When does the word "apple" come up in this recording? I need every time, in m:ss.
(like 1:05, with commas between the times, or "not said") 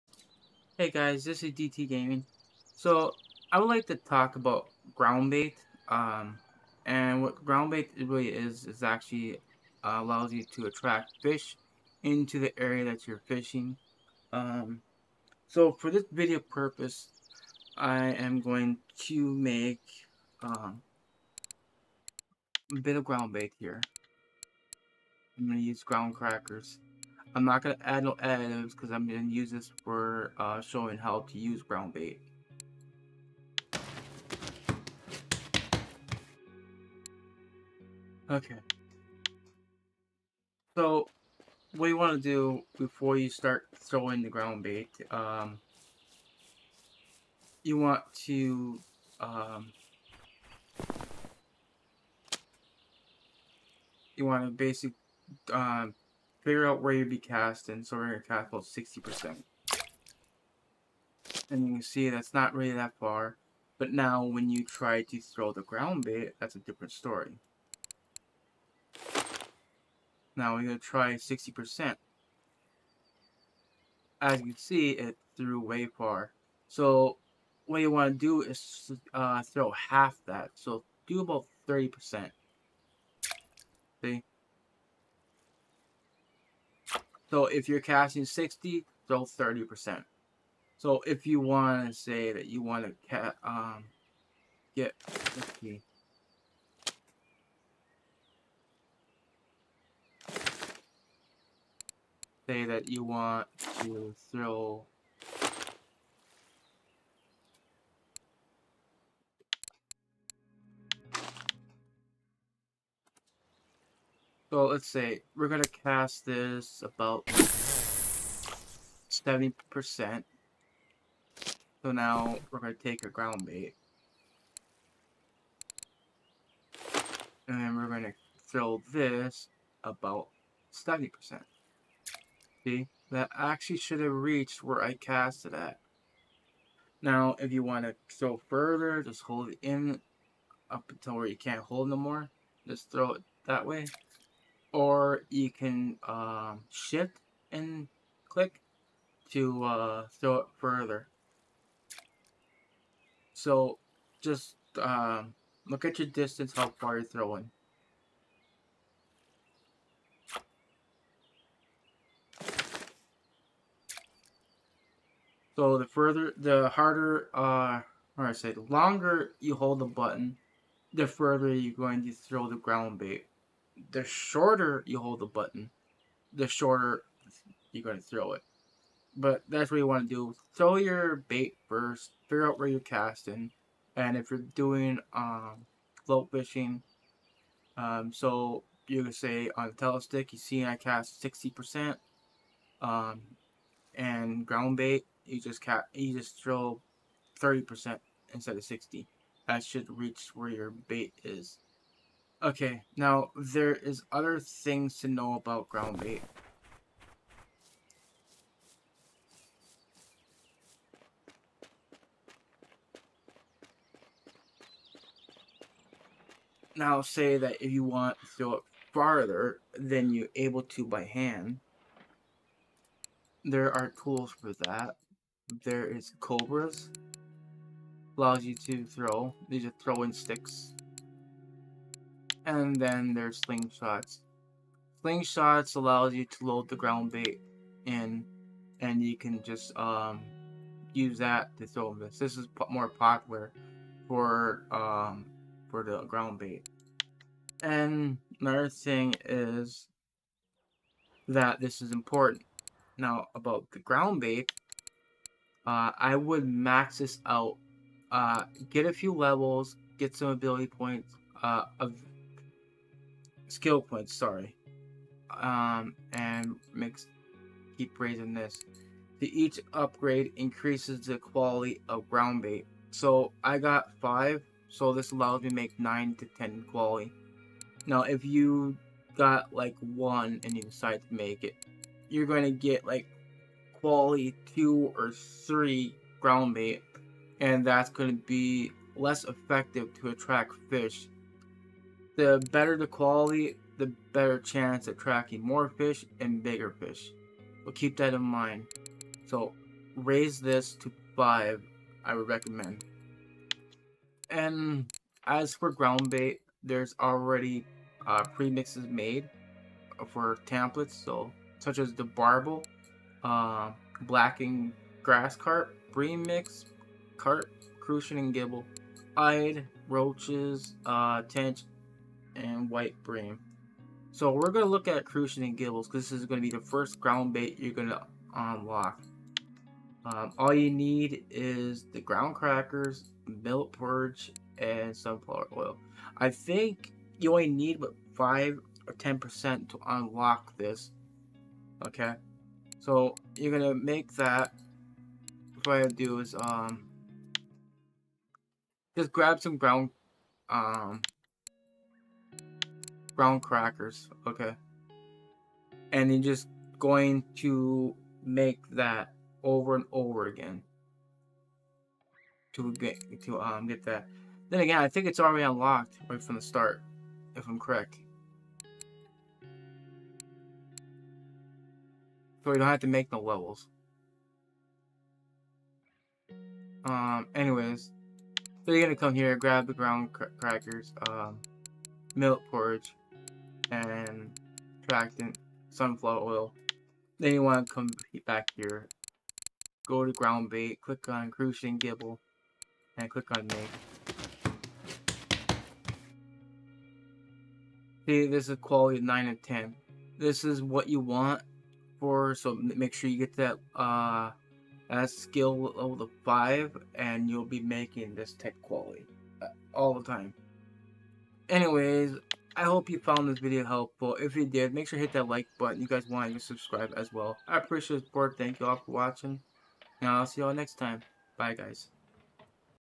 not said.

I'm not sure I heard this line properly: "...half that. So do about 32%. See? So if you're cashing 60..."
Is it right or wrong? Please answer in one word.
wrong.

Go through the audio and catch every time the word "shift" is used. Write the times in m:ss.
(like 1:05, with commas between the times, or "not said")
2:26.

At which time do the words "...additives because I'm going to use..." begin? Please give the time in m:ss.
0:28.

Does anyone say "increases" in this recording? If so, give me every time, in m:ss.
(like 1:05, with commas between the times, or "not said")
4:30.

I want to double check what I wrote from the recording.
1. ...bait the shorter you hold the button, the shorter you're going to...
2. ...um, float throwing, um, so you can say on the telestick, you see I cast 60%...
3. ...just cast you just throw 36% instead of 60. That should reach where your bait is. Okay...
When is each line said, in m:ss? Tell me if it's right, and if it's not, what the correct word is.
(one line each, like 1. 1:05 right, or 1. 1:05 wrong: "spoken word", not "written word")
1. 2:52 right
2. 3:05 wrong: "fishing", not "throwing"
3. 3:15 wrong: "30", not "36".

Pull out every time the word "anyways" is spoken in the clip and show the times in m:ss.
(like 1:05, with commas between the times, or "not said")
6:17, 6:51.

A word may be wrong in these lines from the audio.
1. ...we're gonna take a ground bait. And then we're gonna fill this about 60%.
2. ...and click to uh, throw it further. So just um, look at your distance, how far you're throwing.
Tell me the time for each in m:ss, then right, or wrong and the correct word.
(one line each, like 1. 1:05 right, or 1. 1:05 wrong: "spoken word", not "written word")
1. 2:02 wrong: "70", not "60"
2. 2:27 right.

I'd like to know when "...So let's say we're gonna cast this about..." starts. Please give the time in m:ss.
1:54.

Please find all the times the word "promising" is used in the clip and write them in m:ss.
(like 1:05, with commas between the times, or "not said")
not said.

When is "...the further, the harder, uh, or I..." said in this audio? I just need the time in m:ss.
2:45.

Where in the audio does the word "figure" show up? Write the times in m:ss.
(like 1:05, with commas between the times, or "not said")
0:56, 3:02.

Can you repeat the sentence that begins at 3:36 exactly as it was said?
Now say that if you want to throw it farther than you're able to by hand, there are tools for that.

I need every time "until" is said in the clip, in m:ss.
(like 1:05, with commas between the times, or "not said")
2:20.